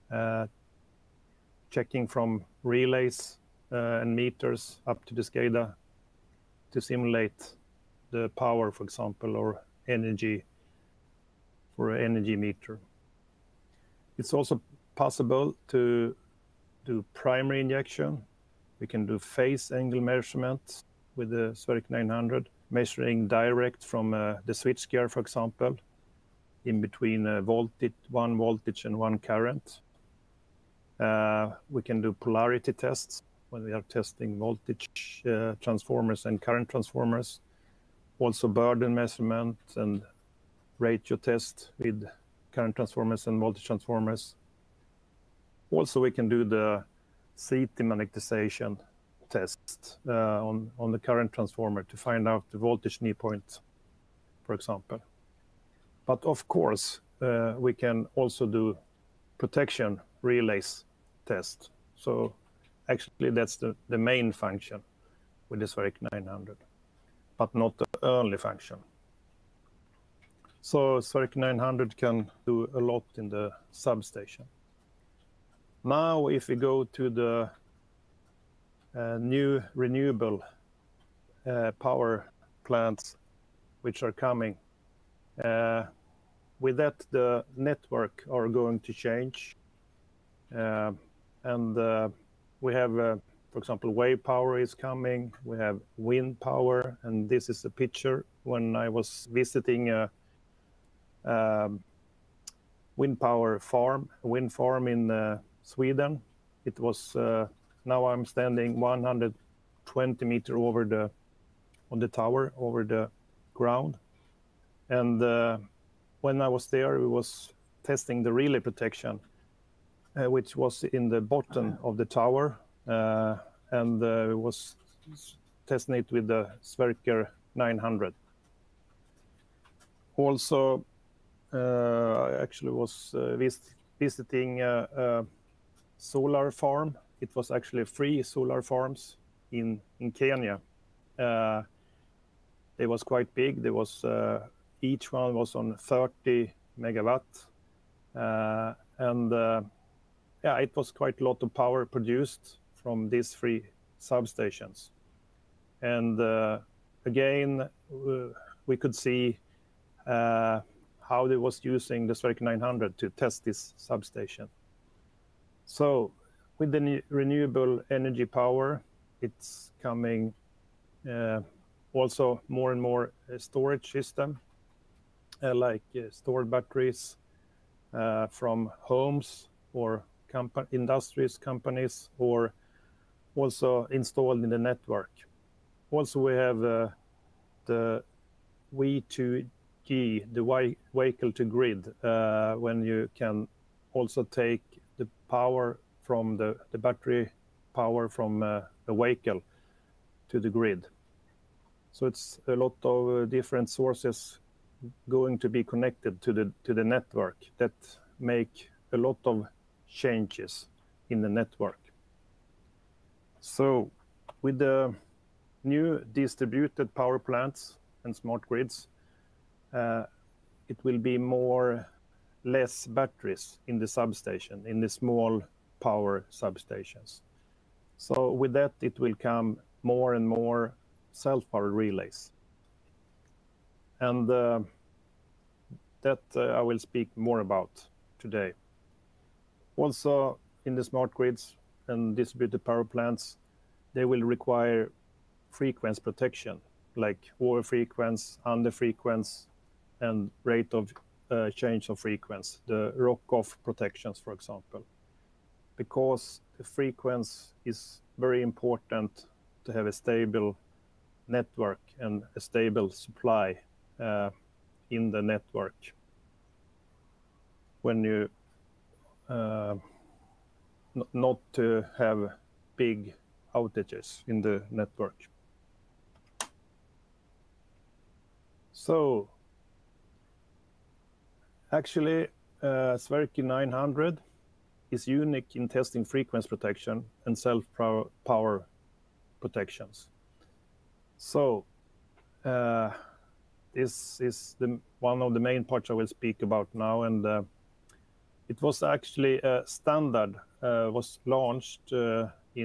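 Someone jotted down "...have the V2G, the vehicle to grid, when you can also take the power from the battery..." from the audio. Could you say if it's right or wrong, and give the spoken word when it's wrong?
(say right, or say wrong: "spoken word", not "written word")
right.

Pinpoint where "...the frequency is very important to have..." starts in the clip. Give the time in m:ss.
4:16.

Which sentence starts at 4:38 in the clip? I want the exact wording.
So Actually, uh, Sverker 900 is unique in testing frequency protection and self-power protections.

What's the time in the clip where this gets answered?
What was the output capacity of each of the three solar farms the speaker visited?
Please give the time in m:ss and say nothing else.
2:25.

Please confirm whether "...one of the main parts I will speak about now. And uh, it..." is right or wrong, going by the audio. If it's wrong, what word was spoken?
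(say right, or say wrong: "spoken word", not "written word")
right.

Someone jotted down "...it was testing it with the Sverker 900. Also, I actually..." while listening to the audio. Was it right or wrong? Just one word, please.
right.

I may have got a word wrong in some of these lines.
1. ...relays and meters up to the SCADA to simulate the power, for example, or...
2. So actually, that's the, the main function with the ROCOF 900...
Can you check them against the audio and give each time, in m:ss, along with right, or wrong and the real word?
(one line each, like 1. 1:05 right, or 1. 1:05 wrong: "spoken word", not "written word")
1. 0:02 right
2. 1:01 wrong: "Sverker", not "ROCOF".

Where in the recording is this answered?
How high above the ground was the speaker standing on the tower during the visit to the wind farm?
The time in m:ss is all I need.
1:48.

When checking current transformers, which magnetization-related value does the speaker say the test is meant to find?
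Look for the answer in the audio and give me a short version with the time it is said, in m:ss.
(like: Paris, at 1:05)
voltage knee point, at 0:52.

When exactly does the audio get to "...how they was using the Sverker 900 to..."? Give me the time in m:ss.
2:41.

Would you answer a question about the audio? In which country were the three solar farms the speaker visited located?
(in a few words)
Kenya.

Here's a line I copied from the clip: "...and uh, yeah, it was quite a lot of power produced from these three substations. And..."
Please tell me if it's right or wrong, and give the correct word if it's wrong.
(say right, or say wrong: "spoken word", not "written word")
right.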